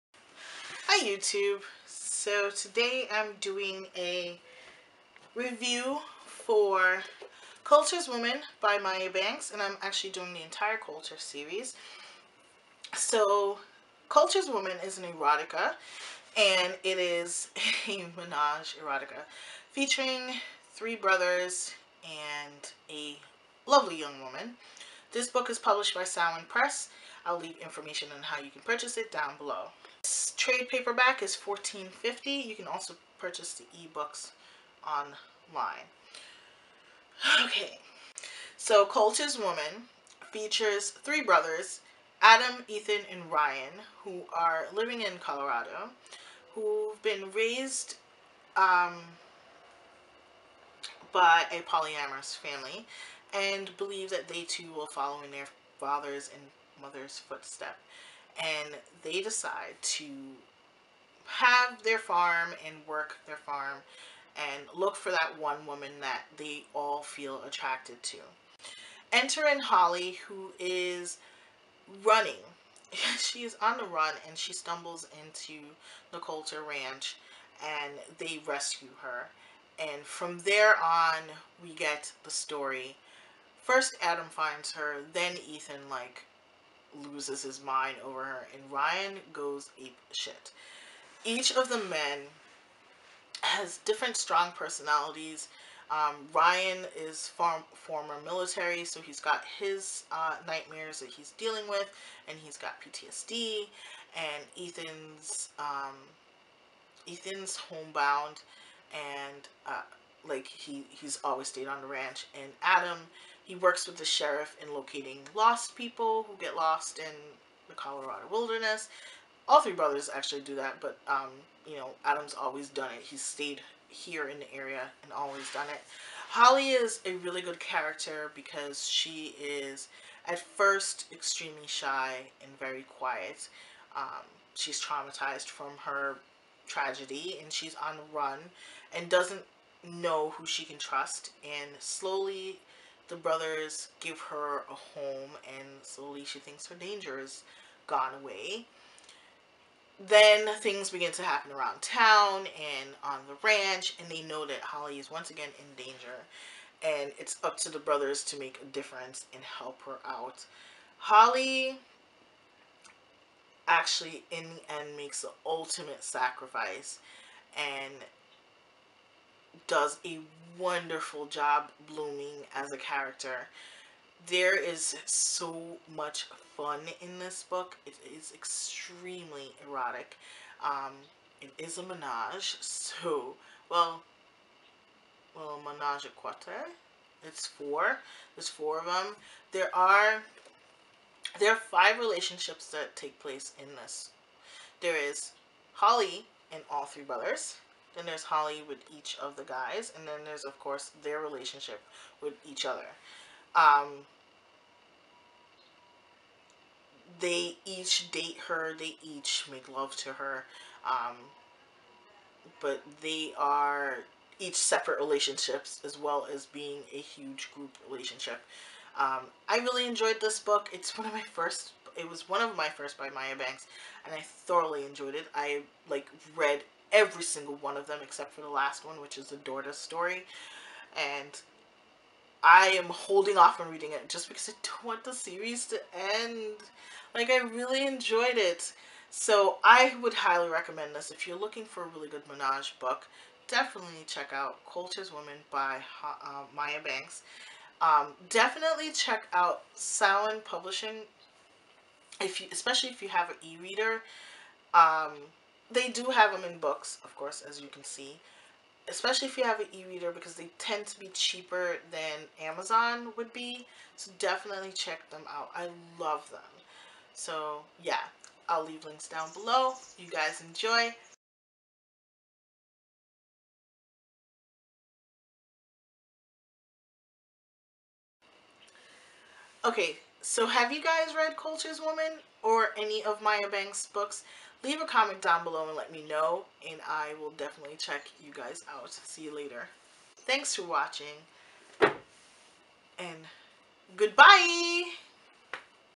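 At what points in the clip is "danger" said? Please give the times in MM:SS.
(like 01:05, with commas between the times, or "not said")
02:26, 02:35.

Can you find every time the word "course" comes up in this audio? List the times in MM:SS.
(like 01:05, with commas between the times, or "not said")
03:20, 04:17.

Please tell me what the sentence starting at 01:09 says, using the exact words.
Enter in Holly, who is running.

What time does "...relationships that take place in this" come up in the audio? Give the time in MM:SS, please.
03:11.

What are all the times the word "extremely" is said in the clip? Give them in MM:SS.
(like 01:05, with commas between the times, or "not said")
02:11, 02:58.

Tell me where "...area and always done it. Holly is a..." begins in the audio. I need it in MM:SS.
02:04.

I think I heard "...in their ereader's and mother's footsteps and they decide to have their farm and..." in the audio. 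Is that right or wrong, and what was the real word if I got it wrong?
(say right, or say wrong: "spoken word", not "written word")
wrong: "father", not "ereader".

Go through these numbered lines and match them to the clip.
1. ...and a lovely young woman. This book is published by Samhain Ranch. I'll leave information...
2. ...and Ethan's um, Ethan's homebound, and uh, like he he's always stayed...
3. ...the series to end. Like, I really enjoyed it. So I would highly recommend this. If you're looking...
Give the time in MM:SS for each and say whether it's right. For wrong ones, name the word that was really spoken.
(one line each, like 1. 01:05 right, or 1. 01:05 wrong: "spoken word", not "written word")
1. 00:22 wrong: "Press", not "Ranch"
2. 01:44 right
3. 03:55 right.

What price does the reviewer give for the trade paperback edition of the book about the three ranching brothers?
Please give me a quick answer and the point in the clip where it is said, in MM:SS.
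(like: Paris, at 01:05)
$14.50, at 00:31.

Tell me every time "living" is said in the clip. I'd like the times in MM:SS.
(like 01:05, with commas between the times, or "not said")
00:44.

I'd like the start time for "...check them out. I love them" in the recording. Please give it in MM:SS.
04:24.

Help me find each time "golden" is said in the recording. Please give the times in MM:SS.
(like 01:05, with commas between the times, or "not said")
not said.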